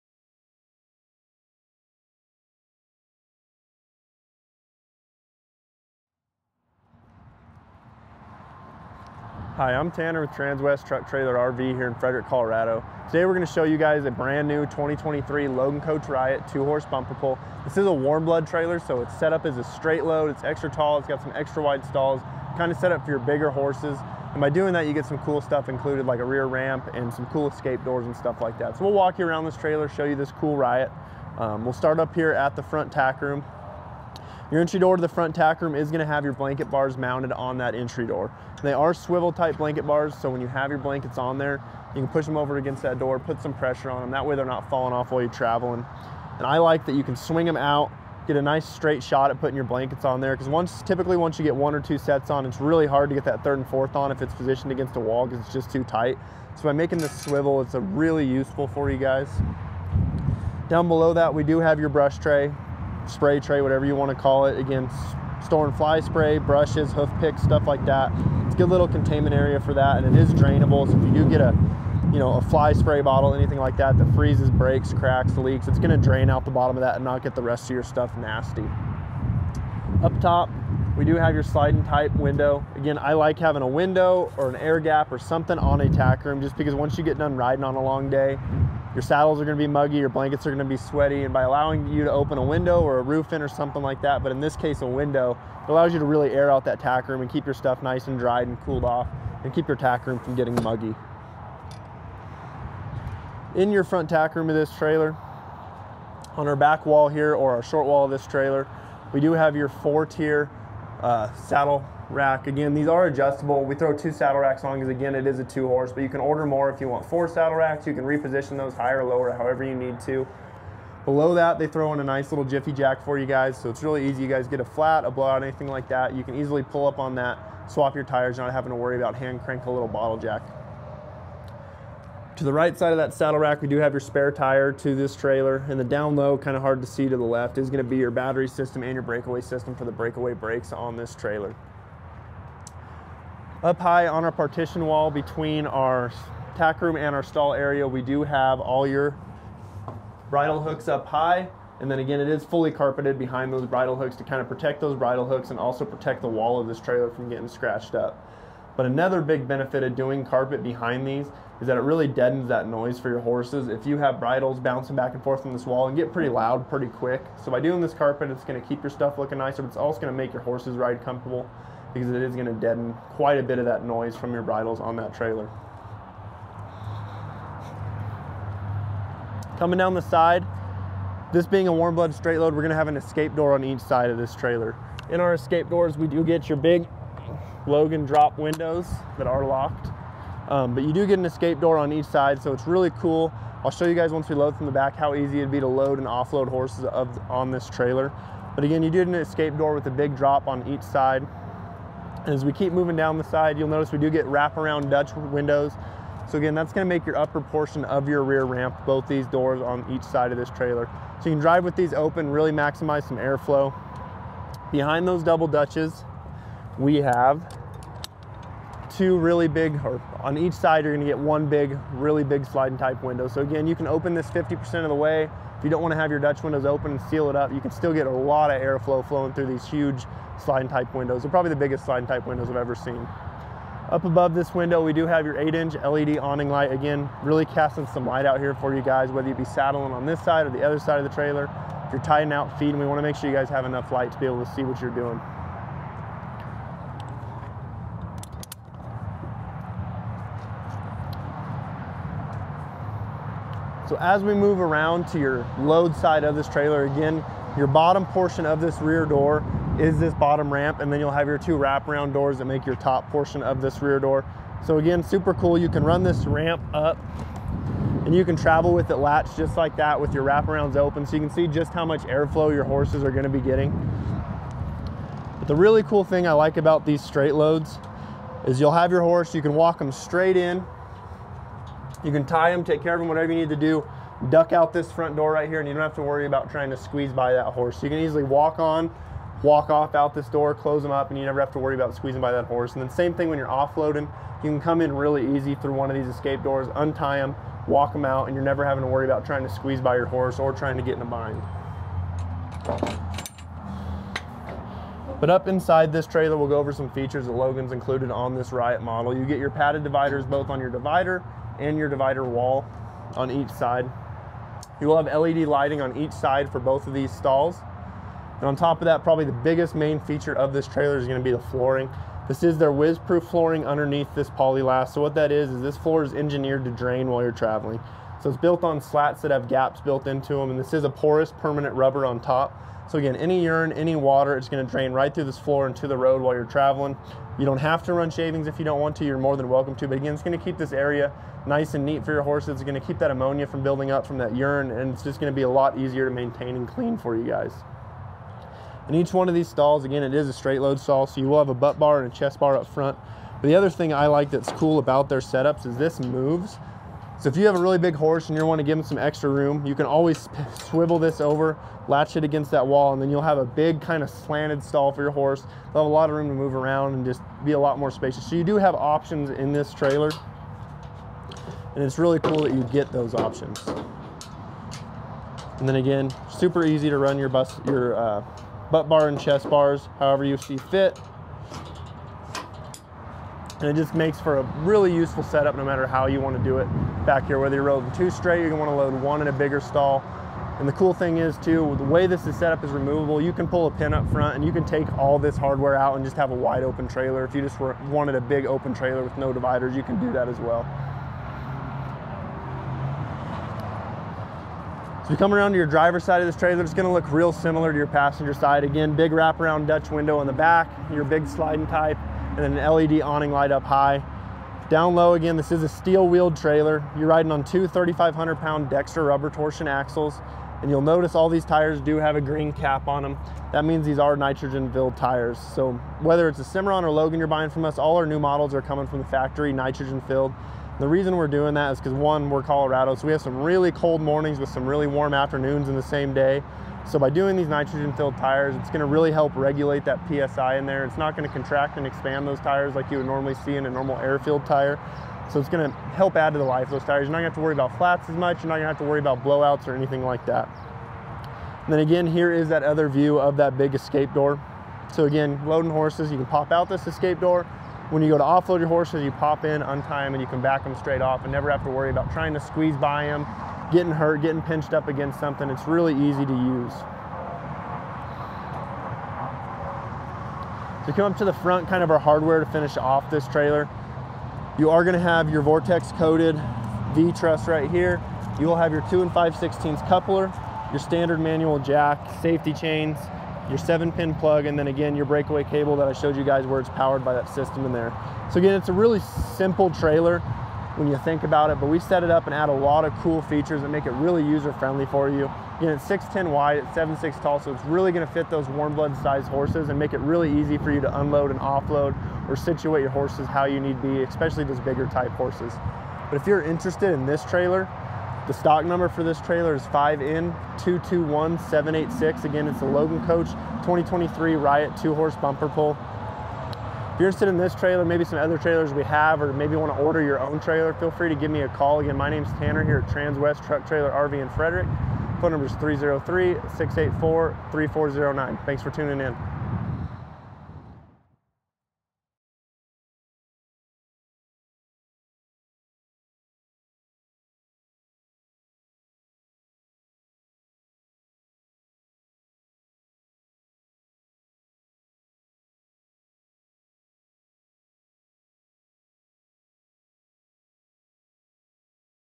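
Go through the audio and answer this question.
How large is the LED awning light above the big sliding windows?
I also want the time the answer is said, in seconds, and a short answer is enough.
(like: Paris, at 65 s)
8 inch, at 235 s.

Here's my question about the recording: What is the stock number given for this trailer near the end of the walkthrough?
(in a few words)
5N221786.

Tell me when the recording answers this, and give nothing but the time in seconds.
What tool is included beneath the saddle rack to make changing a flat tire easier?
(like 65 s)
122 s.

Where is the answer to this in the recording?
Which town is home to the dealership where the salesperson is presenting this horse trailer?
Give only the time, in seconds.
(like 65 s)
11 s.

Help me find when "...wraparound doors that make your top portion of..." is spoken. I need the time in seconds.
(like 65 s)
261 s.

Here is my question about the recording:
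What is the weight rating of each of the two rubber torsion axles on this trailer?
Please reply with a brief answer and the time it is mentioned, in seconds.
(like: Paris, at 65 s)
3,500 pounds, at 417 s.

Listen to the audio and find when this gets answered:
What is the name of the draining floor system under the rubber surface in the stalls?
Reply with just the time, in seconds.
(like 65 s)
322 s.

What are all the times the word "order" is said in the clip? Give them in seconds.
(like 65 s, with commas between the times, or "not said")
116 s, 519 s.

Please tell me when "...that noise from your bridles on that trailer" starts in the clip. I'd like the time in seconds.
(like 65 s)
173 s.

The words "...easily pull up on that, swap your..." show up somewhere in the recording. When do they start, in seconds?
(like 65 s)
126 s.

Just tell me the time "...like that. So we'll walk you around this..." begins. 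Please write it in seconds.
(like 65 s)
28 s.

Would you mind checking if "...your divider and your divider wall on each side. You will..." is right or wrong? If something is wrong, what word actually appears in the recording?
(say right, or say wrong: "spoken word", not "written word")
right.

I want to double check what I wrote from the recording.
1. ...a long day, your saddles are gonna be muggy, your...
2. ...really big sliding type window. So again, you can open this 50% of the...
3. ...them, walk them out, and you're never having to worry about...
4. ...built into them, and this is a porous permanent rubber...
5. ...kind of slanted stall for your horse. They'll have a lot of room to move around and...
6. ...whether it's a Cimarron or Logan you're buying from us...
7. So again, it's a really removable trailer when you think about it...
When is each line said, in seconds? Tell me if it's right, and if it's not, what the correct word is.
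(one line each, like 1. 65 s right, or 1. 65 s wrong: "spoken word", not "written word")
1. 87 s right
2. 221 s right
3. 297 s right
4. 329 s right
5. 363 s right
6. 426 s right
7. 488 s wrong: "simple", not "removable".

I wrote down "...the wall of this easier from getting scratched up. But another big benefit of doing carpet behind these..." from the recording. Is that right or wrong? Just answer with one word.
wrong.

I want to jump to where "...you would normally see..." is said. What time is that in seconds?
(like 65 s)
442 s.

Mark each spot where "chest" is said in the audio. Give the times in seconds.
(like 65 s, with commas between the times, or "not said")
352 s, 379 s.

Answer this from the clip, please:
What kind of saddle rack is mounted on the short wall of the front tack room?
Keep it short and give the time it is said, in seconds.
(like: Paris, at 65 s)
Four tier, at 109 s.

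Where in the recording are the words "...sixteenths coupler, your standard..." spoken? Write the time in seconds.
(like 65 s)
479 s.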